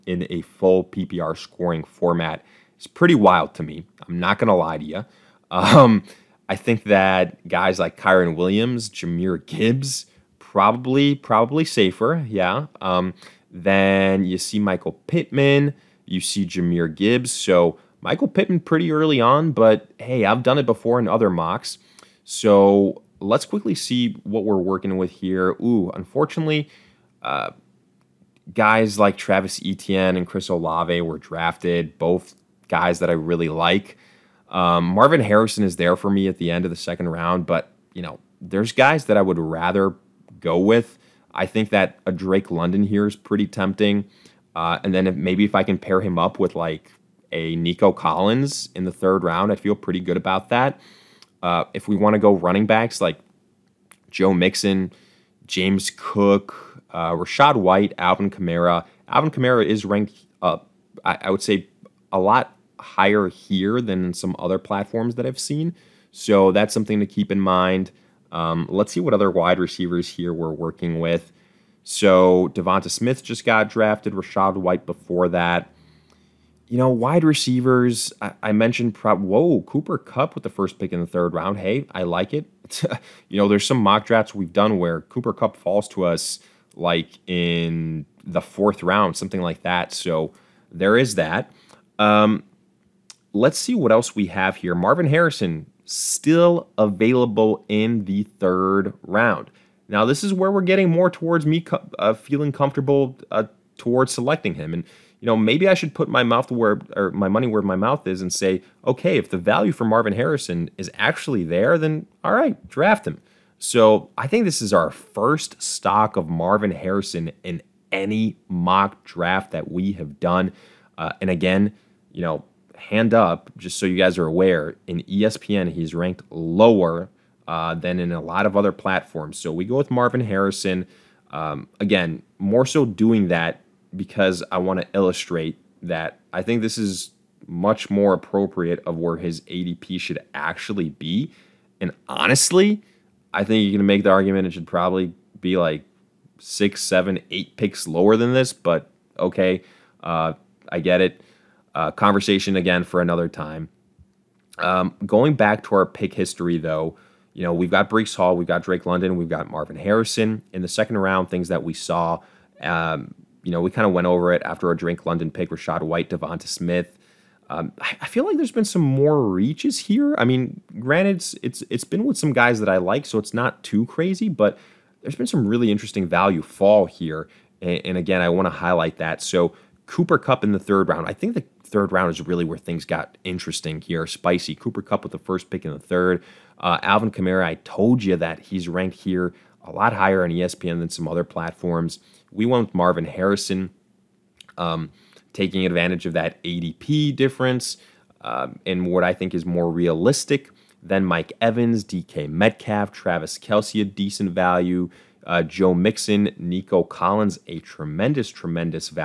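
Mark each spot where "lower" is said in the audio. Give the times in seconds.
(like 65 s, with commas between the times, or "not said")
126 s, 147 s.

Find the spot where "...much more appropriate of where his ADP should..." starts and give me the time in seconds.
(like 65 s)
137 s.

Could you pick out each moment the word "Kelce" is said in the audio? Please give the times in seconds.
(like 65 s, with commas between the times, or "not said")
203 s.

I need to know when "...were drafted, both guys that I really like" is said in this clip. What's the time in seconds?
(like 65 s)
30 s.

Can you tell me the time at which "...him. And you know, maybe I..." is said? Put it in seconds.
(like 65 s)
104 s.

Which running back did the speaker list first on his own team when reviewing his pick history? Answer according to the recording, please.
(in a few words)
Breece Hall.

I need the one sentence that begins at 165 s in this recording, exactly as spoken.
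London pick, Rachaad White, DeVonta Smith.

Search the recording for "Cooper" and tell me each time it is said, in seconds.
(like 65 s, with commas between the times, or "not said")
79 s, 85 s, 179 s, 184 s.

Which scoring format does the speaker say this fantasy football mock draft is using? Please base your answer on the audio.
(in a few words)
Full PPR.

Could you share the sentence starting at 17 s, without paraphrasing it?
So Michael Pittman pretty early on, but hey, I've done it before in other mocks.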